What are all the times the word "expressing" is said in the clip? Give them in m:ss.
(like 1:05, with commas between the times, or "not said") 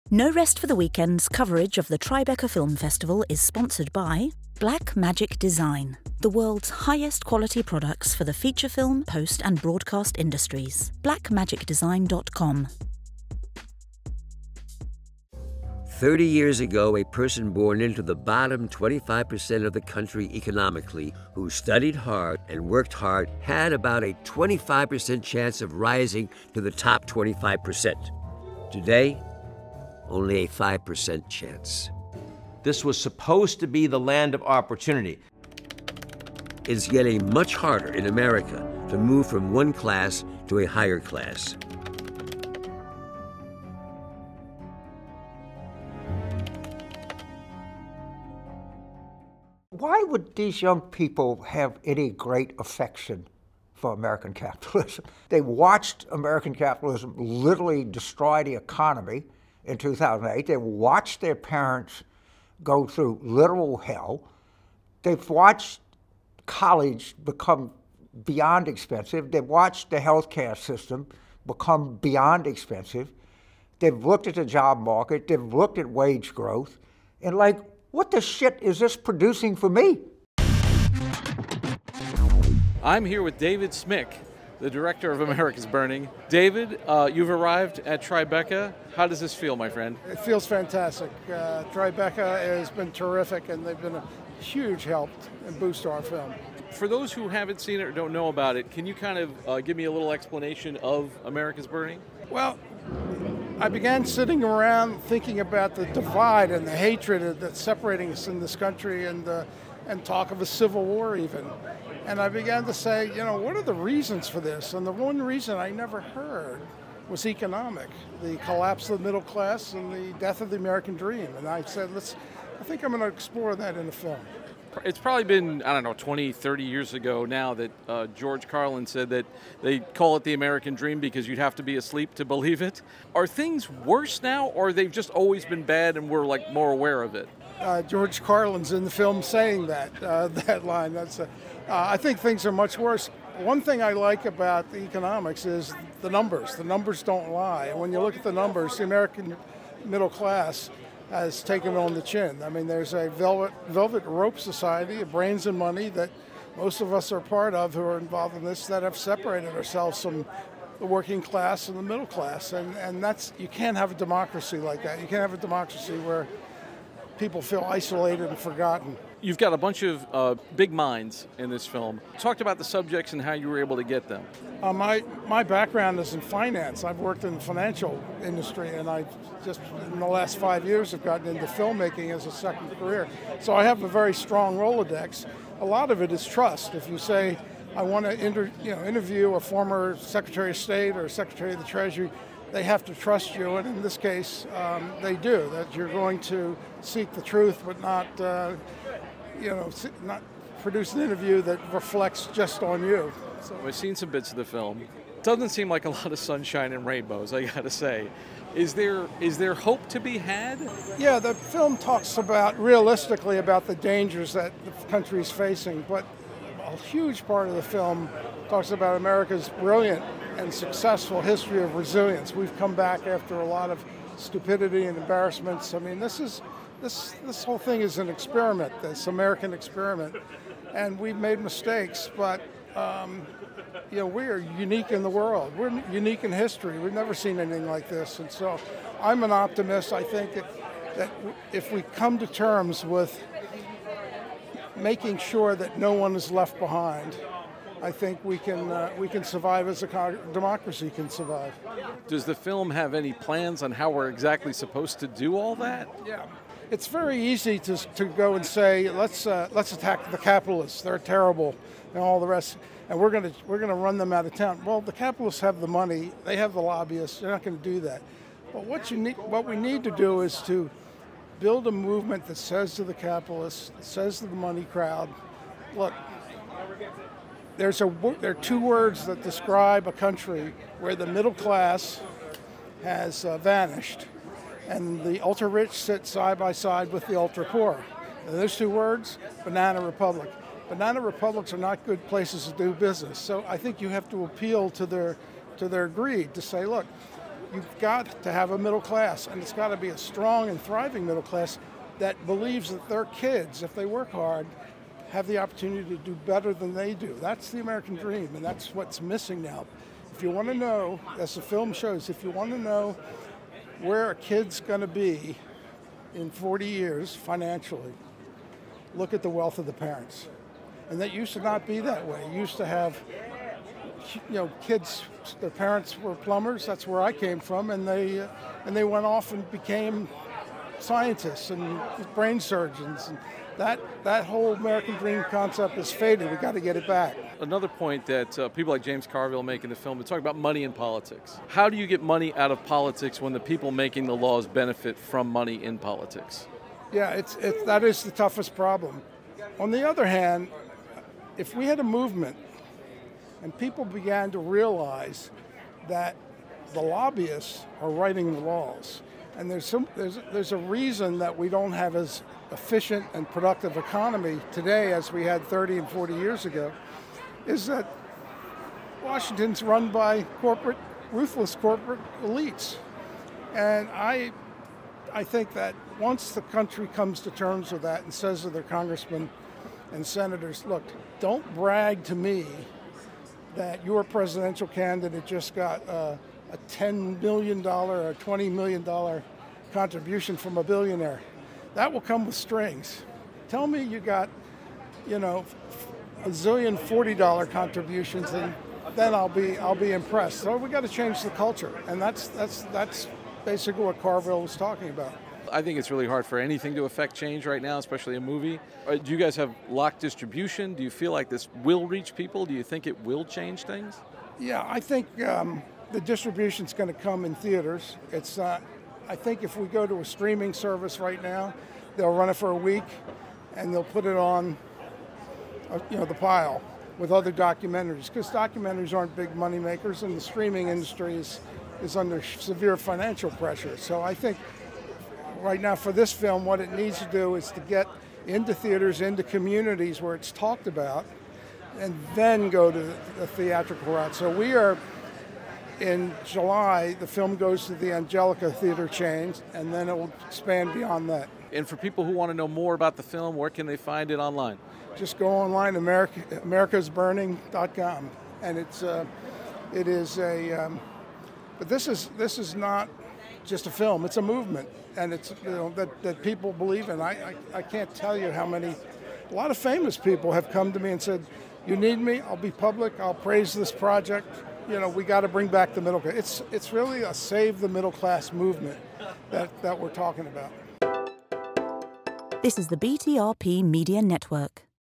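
not said.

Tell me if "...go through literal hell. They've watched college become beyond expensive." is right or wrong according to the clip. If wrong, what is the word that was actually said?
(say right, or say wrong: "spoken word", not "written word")
right.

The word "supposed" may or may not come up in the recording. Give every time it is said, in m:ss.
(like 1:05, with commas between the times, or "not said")
0:32, 4:14.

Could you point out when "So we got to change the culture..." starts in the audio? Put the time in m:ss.
6:40.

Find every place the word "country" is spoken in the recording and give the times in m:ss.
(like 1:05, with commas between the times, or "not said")
0:19, 1:48, 3:34, 4:39, 6:16.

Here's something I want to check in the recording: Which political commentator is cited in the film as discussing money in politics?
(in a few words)
James Carville.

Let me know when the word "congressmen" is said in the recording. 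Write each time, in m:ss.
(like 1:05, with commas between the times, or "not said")
6:18.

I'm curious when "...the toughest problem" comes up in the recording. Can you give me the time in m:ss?
5:48.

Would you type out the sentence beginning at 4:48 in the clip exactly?
And those two words, banana republic.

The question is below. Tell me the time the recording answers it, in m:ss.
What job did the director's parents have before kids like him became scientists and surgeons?
5:26.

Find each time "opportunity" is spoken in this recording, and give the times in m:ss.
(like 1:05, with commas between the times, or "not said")
0:34, 5:05.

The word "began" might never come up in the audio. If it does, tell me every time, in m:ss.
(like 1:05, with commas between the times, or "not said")
1:43, 1:52, 5:53.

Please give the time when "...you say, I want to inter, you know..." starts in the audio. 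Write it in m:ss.
3:06.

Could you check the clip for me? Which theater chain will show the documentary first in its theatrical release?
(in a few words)
Angelika.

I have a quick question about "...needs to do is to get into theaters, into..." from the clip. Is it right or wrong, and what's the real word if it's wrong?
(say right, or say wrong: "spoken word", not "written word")
right.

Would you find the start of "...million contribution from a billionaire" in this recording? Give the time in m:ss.
6:28.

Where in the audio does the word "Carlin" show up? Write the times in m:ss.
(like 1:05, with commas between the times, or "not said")
2:08, 2:18.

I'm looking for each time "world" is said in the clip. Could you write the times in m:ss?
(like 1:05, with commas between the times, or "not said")
0:06, 3:55.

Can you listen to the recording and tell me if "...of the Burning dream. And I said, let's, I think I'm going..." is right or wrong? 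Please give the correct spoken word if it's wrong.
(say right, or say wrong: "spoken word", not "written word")
wrong: "American", not "Burning".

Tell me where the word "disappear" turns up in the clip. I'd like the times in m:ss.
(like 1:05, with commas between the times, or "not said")
not said.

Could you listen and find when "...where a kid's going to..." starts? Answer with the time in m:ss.
5:13.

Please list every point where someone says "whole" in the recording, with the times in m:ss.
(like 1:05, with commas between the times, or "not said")
3:47, 5:34.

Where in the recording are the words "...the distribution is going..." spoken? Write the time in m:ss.
6:55.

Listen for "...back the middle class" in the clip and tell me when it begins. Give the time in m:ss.
7:55.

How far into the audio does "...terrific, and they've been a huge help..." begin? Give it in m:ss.
1:32.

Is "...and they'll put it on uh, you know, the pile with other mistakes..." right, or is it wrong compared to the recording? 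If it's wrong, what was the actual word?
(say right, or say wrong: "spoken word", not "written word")
wrong: "documentaries", not "mistakes".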